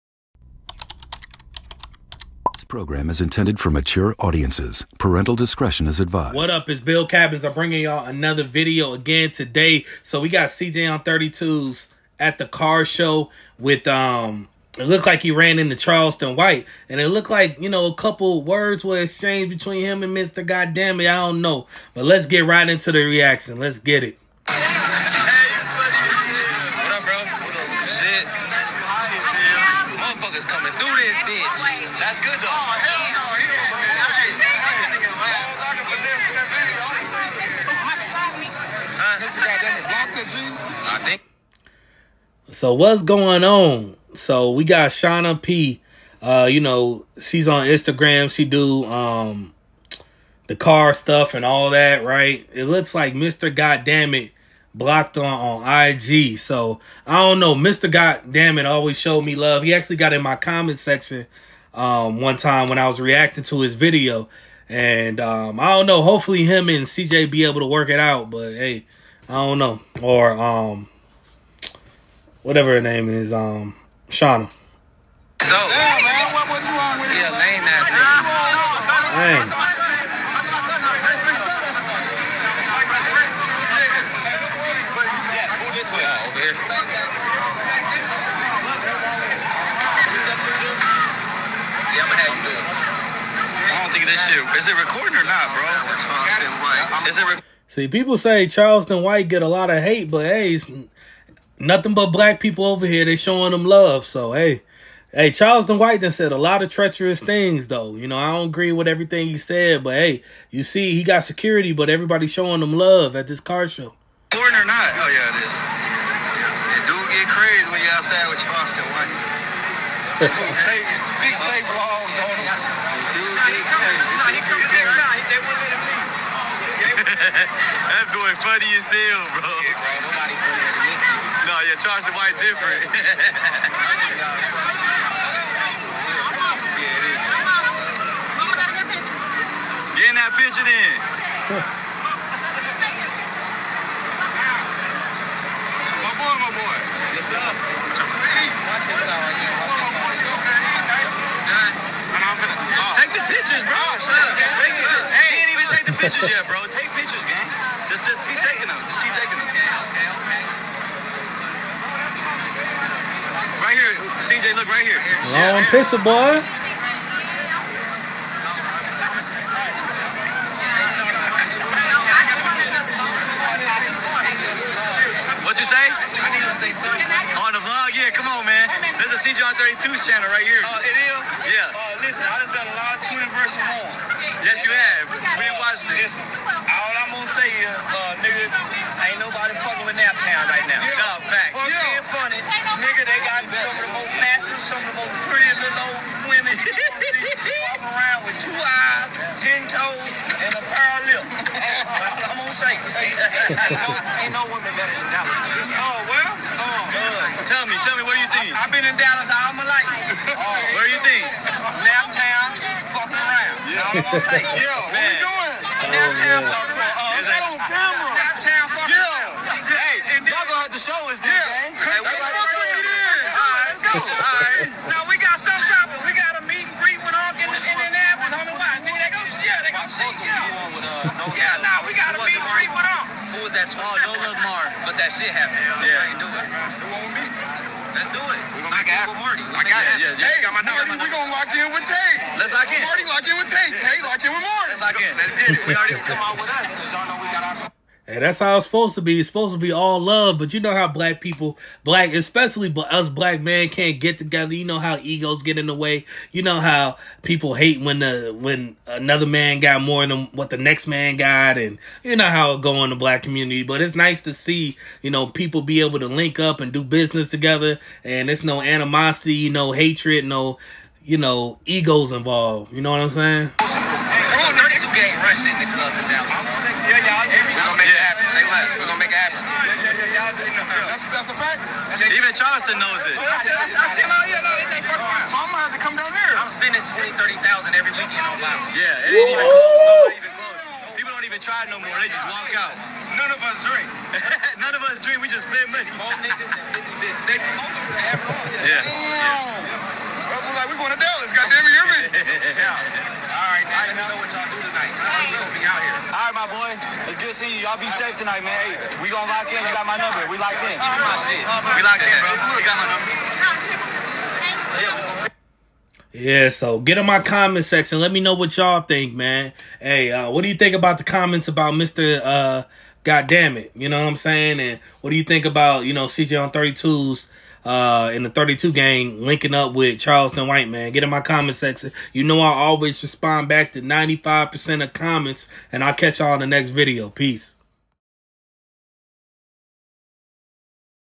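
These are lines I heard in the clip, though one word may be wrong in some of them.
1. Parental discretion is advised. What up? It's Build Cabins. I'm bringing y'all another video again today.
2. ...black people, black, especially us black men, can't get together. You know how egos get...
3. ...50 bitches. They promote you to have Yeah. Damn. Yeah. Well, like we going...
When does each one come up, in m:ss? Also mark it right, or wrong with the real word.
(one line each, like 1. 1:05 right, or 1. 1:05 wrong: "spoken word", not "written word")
1. 0:04 right
2. 4:10 right
3. 4:56 right.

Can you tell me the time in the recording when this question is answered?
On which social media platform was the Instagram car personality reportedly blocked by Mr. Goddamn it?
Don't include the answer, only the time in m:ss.
0:55.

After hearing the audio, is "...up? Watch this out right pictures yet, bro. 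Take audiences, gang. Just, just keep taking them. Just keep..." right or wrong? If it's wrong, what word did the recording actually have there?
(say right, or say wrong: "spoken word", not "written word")
wrong: "pictures", not "audiences".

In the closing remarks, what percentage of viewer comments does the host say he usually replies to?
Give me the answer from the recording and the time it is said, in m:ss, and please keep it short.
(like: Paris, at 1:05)
95%, at 5:33.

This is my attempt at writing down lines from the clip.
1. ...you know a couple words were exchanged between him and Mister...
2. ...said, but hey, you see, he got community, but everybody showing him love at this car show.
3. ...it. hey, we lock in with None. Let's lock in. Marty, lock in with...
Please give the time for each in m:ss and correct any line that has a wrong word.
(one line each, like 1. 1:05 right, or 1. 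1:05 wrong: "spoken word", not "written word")
1. 0:17 right
2. 1:49 wrong: "security", not "community"
3. 3:59 wrong: "Tate", not "None".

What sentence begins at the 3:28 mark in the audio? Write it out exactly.
I've been in Dallas all my life.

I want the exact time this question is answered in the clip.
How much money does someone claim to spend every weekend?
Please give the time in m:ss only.
4:46.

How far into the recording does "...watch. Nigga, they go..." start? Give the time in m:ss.
3:48.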